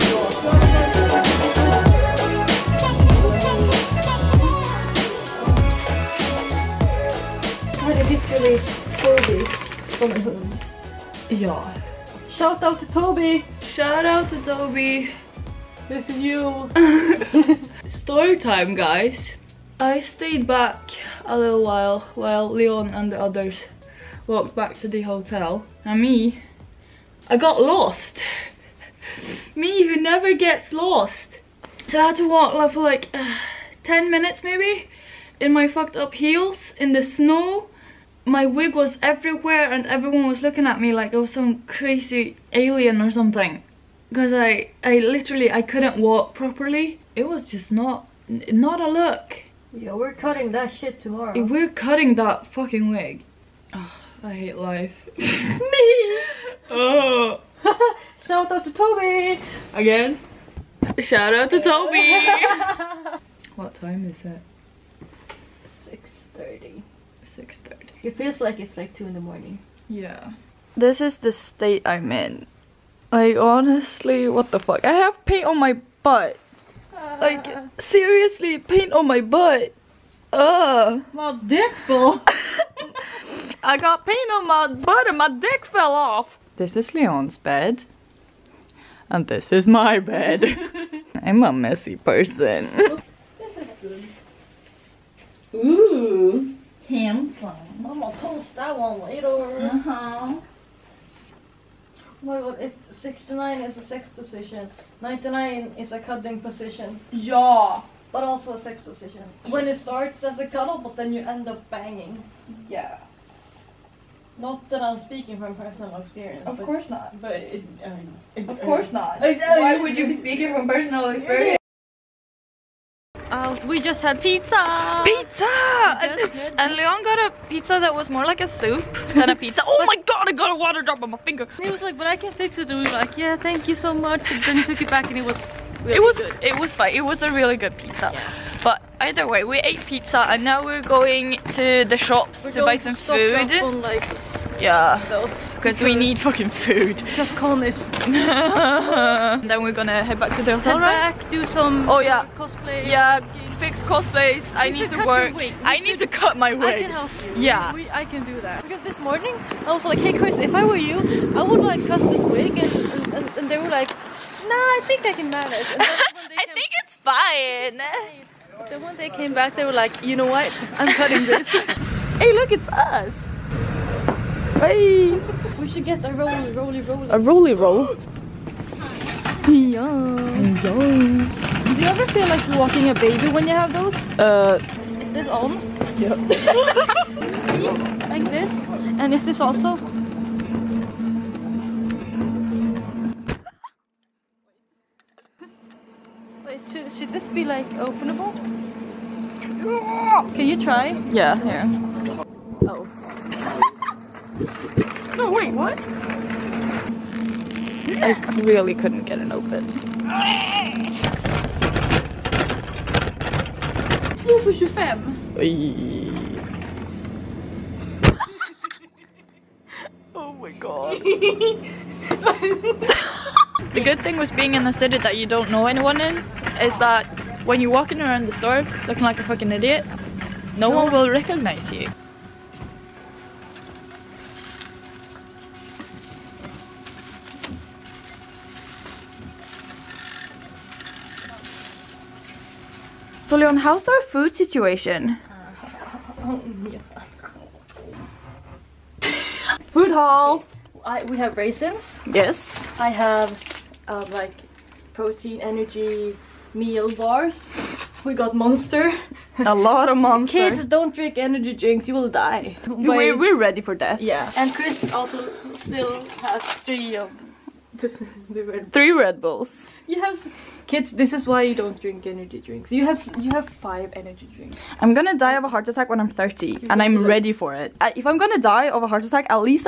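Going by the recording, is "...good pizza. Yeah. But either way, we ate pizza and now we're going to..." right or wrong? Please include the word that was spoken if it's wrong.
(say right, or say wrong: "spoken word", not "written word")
right.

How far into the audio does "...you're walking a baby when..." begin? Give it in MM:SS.
03:02.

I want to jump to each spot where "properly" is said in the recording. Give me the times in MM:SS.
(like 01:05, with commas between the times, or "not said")
00:46.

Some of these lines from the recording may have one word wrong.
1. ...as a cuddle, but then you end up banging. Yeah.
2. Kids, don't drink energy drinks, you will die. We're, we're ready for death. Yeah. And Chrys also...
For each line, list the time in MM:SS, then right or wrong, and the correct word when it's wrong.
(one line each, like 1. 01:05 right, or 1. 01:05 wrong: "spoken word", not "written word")
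1. 01:50 right
2. 04:20 right.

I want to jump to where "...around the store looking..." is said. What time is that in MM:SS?
03:48.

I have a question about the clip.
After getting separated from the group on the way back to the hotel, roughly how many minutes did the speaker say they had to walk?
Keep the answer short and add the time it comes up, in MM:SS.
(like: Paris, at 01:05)
10 minutes, at 00:33.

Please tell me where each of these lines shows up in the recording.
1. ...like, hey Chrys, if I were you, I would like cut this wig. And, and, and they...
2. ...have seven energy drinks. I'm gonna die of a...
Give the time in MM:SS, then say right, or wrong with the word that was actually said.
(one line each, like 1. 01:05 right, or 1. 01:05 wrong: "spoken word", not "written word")
1. 02:39 right
2. 04:33 wrong: "five", not "seven".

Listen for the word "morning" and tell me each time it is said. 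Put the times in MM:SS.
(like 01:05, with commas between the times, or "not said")
01:09, 02:38.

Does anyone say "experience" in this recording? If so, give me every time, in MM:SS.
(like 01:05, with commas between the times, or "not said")
01:55, 02:01.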